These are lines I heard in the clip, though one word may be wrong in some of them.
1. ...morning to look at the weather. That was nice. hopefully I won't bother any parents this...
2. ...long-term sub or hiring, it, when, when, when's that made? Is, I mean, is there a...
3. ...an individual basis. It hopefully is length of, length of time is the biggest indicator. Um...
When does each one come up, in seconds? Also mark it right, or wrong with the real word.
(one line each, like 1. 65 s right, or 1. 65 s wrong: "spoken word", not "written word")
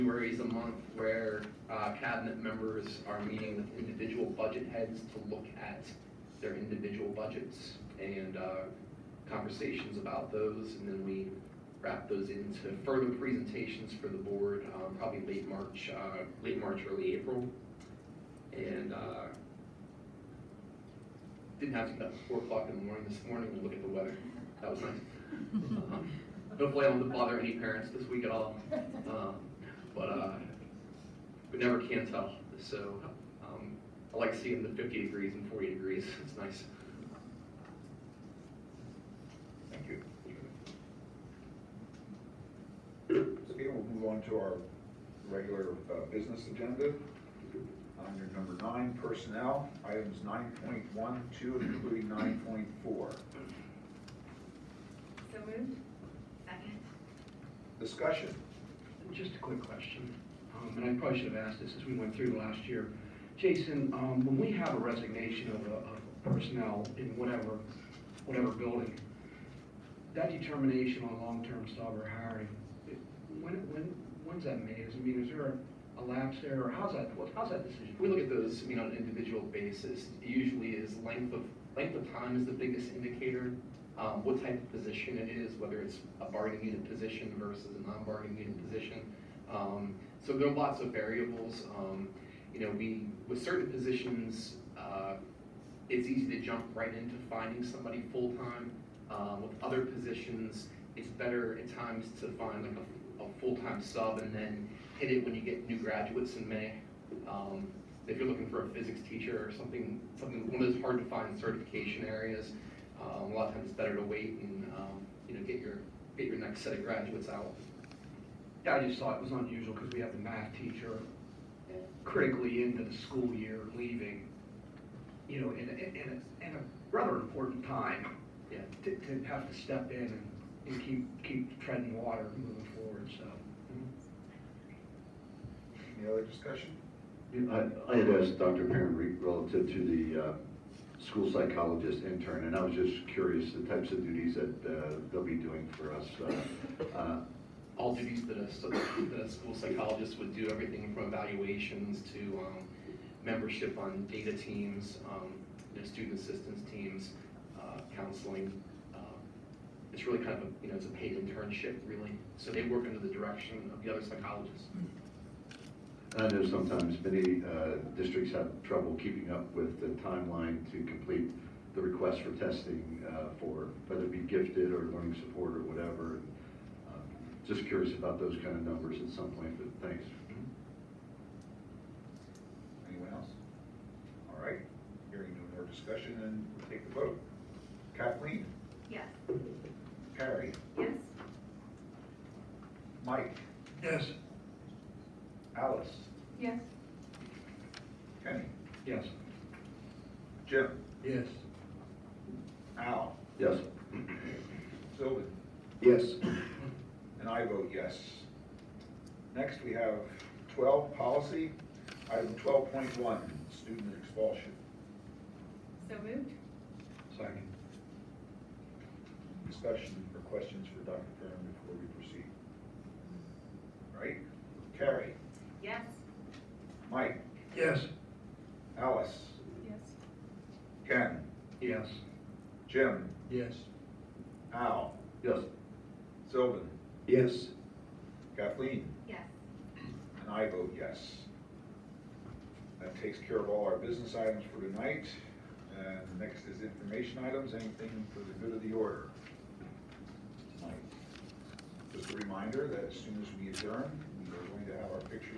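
1. 23 s right
2. 71 s right
3. 78 s wrong: "usually", not "hopefully".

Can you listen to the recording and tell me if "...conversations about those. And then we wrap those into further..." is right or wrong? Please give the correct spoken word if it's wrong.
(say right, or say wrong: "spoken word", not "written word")
right.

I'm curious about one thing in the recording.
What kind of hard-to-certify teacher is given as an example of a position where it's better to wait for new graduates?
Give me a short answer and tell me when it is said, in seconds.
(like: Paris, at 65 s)
physics teacher, at 108 s.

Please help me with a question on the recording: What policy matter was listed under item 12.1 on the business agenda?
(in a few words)
student expulsion.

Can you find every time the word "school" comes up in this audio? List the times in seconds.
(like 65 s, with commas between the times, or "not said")
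122 s, 141 s, 149 s.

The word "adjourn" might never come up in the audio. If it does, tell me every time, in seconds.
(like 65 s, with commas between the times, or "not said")
253 s.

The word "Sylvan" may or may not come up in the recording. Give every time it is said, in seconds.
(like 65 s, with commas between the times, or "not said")
204 s, 236 s.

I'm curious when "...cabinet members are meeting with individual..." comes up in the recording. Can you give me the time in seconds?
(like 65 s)
1 s.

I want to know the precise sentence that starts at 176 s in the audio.
Um, just curious about those kind of numbers at some point, but thanks.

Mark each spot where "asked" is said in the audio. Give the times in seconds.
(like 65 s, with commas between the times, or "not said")
61 s, 138 s.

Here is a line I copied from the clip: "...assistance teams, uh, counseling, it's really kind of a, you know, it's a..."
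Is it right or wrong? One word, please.
right.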